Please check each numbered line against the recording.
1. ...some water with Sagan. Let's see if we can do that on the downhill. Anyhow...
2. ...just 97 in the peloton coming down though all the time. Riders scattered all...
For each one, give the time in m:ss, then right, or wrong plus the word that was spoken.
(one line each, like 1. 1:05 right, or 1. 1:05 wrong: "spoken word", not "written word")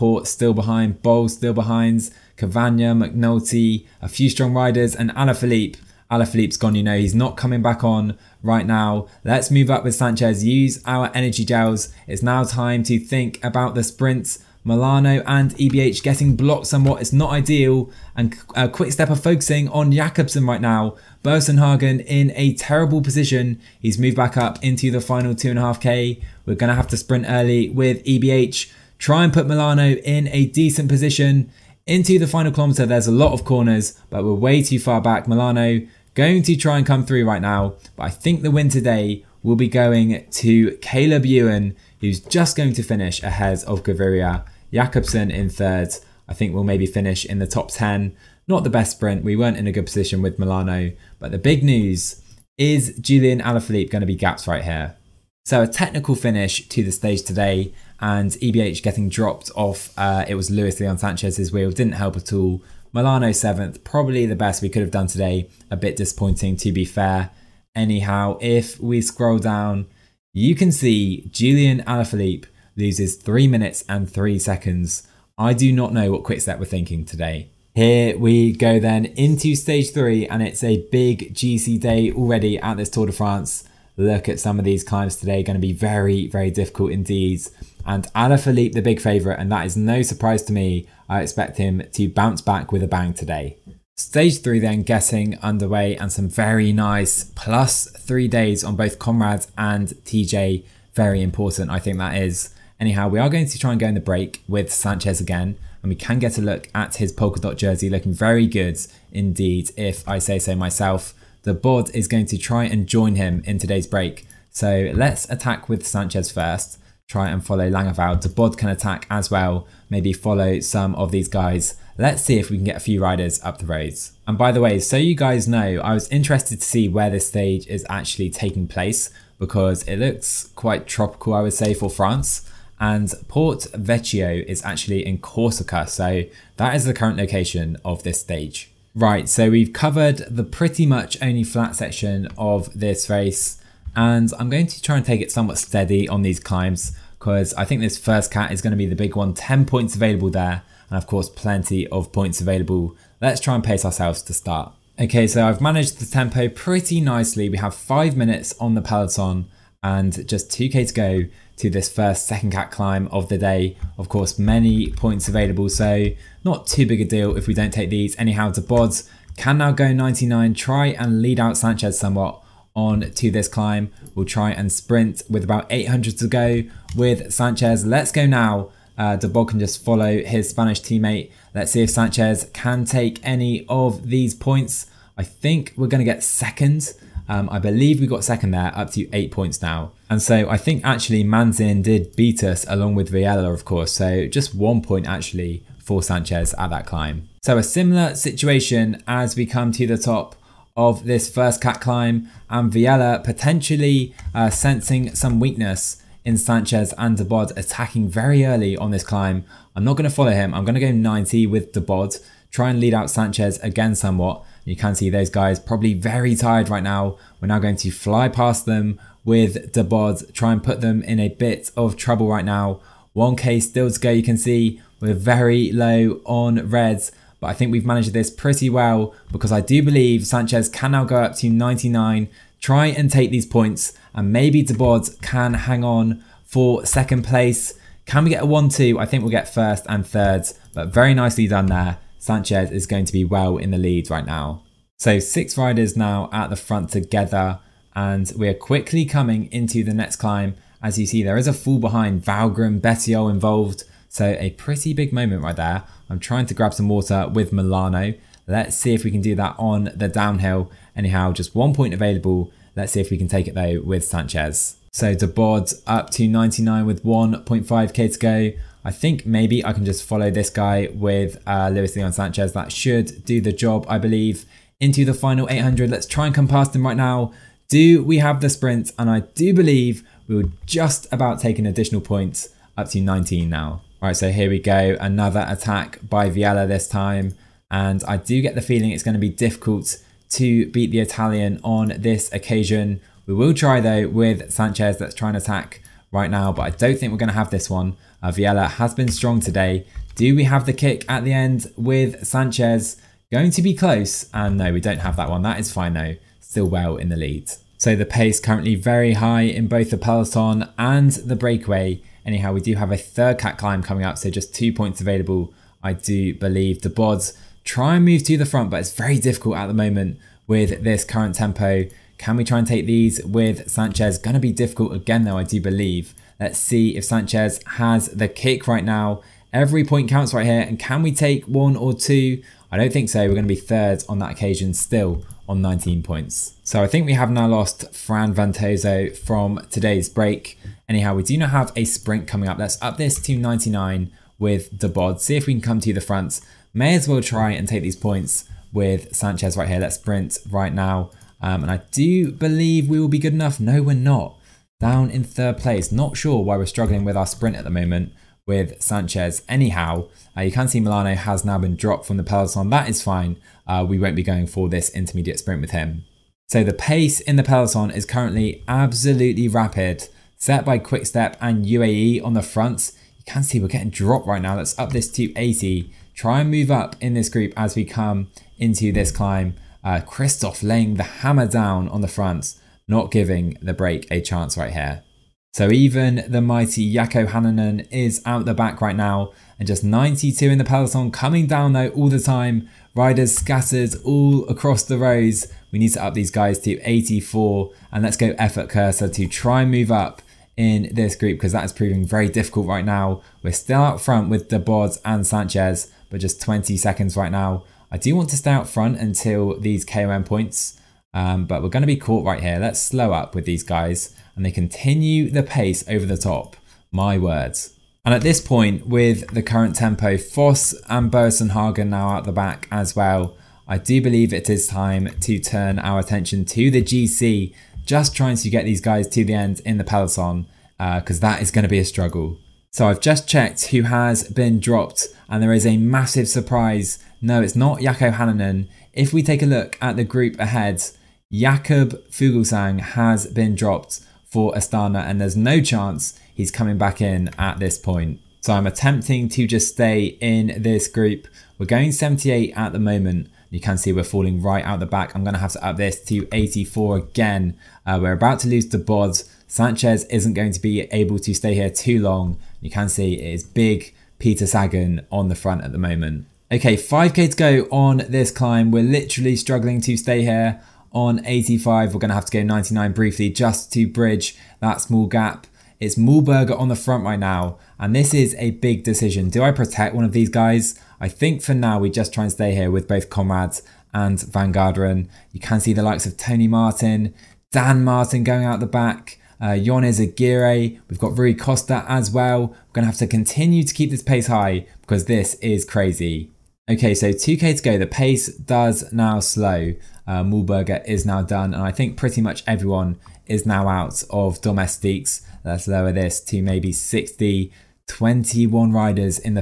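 1. 4:16 wrong: "Molano", not "Sagan"
2. 6:29 wrong: "92", not "97".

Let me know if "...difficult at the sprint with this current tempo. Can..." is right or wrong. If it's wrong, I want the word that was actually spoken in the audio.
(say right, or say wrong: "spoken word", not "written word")
wrong: "moment", not "sprint".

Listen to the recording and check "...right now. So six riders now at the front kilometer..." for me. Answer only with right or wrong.
wrong.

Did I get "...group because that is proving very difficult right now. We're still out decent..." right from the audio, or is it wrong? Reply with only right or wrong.
wrong.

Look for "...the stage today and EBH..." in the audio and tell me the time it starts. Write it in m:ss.
0:56.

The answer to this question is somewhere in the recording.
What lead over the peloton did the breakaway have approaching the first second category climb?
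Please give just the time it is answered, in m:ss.
2:37.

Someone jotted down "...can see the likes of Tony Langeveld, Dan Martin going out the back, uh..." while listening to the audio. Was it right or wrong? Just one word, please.
wrong.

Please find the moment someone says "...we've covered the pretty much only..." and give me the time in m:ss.
2:19.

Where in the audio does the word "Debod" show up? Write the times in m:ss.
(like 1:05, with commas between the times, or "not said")
3:27, 3:31, 3:39, 5:44.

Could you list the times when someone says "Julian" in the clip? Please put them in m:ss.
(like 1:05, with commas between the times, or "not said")
0:52, 1:11.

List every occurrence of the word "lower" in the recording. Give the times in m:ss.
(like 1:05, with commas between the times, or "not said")
8:25.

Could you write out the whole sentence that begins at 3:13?
So just one point actually for Sanchez at that climb.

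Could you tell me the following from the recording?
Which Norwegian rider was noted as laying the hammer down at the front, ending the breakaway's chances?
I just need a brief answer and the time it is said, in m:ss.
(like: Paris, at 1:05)
Kristoff, at 6:20.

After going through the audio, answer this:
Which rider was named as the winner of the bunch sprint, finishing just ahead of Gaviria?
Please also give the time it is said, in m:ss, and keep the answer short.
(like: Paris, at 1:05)
Caleb Ewan, at 0:40.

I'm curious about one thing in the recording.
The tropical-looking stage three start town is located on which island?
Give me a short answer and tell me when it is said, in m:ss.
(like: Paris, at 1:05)
Corsica, at 2:15.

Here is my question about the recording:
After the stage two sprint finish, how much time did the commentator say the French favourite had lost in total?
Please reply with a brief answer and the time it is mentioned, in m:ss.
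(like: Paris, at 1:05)
3 minutes and 3 seconds, at 1:13.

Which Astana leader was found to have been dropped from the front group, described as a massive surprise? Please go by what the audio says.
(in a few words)
Jakob Fuglsang.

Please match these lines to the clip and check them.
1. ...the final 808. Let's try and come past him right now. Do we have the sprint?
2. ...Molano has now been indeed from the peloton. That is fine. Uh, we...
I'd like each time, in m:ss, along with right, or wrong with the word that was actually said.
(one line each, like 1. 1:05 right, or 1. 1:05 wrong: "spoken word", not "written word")
1. 4:35 wrong: "800", not "808"
2. 6:00 wrong: "dropped", not "indeed".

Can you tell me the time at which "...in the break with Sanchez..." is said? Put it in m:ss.
1:43.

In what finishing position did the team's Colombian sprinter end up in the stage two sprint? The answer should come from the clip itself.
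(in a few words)
7th.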